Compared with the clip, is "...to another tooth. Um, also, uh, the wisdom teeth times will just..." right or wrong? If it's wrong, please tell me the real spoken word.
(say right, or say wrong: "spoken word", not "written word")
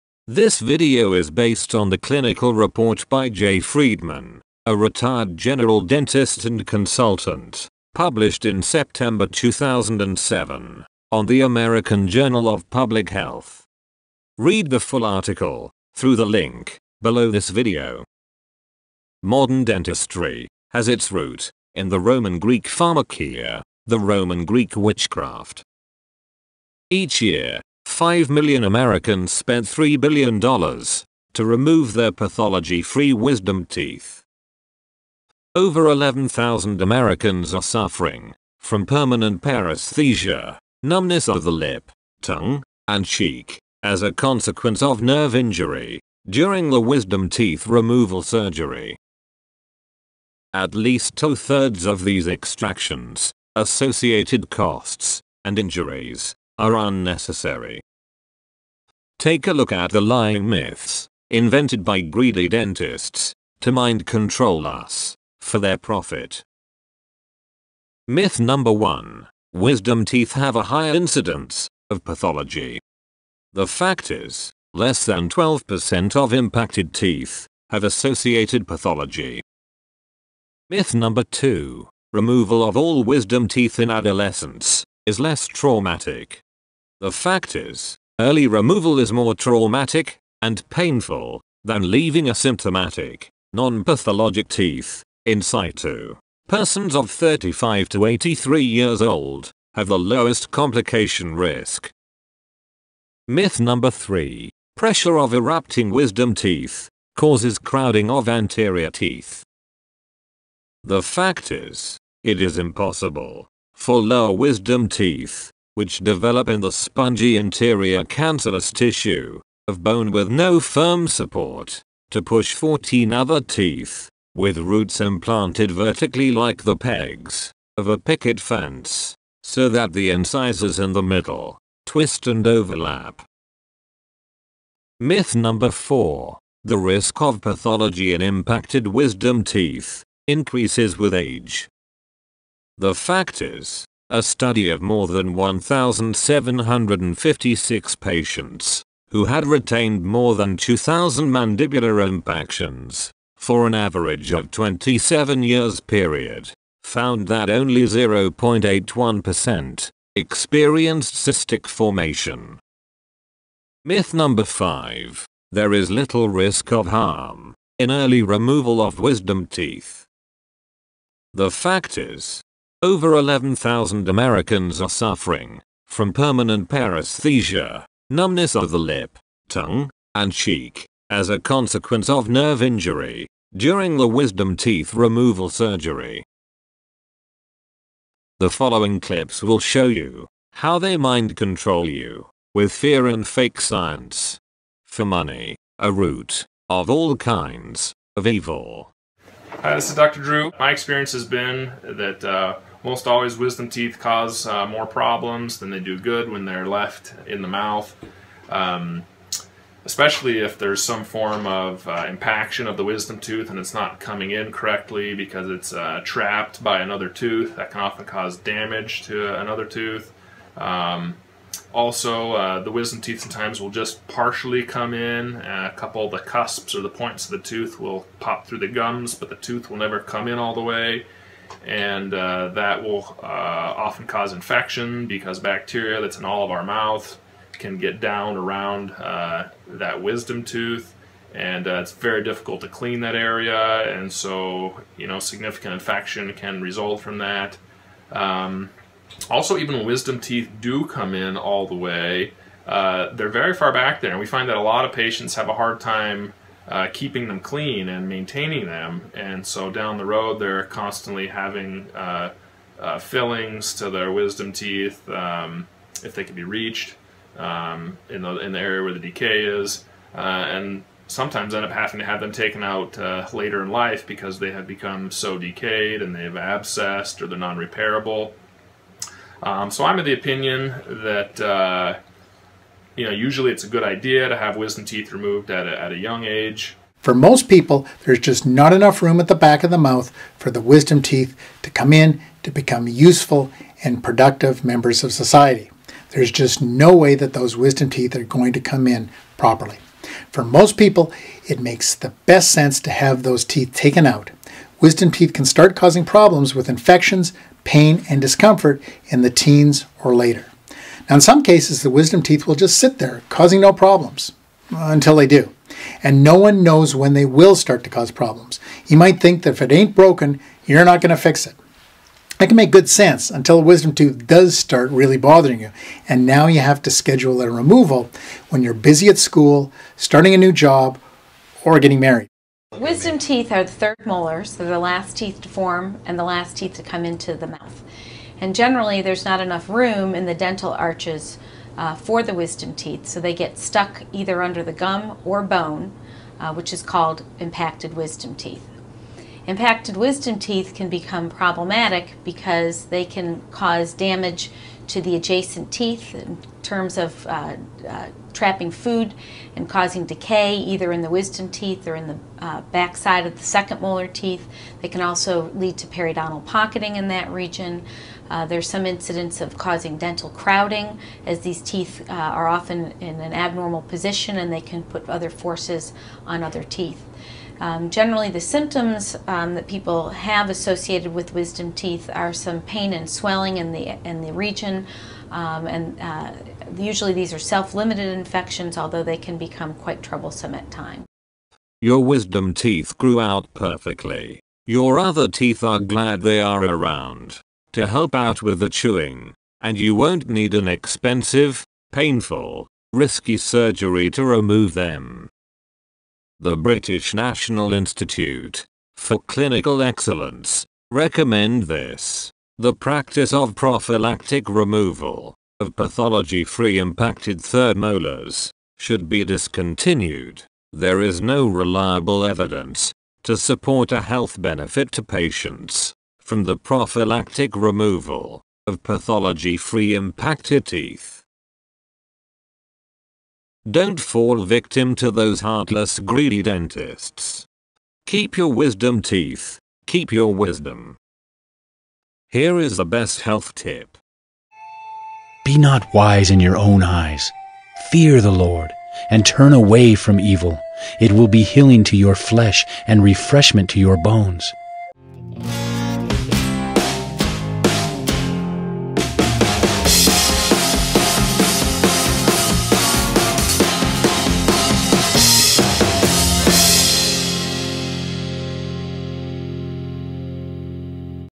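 wrong: "sometimes", not "times".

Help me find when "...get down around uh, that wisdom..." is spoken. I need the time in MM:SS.
03:57.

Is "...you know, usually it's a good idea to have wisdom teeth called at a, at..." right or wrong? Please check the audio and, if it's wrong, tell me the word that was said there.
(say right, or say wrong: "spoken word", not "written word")
wrong: "removed", not "called".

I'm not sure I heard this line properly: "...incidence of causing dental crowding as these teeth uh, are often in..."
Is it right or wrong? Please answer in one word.
right.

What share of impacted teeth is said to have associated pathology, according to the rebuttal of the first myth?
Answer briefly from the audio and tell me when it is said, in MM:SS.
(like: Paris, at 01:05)
less than 12%, at 01:14.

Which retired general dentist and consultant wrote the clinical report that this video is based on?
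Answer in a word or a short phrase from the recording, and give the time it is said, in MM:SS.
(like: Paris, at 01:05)
Jay Friedman, at 00:03.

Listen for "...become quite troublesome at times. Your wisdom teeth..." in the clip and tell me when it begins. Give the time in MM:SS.
06:29.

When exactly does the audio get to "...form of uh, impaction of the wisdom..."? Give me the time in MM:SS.
03:31.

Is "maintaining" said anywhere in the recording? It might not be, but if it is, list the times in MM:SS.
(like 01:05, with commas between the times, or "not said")
04:18.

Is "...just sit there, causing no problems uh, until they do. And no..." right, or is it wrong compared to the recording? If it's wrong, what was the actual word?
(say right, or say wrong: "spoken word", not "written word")
right.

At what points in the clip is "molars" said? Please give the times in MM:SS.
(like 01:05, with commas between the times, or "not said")
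05:34, 06:03, 06:57.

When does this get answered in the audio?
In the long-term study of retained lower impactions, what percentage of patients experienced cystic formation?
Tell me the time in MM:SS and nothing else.
02:37.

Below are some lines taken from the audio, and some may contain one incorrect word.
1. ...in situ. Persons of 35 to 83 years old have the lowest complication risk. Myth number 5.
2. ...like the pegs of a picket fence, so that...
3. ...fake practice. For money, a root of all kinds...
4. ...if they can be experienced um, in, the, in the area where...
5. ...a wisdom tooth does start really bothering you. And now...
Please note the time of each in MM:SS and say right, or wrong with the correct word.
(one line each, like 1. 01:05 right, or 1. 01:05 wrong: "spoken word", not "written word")
1. 01:35 wrong: "3", not "5"
2. 02:06 right
3. 03:13 wrong: "science", not "practice"
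4. 04:26 wrong: "reached", not "experienced"
5. 05:23 right.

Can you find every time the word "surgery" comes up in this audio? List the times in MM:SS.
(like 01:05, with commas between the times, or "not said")
00:48, 03:05, 06:43.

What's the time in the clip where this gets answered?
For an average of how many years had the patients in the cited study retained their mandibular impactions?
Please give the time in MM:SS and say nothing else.
02:34.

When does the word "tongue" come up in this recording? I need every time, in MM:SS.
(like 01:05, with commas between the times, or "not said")
00:42, 02:59.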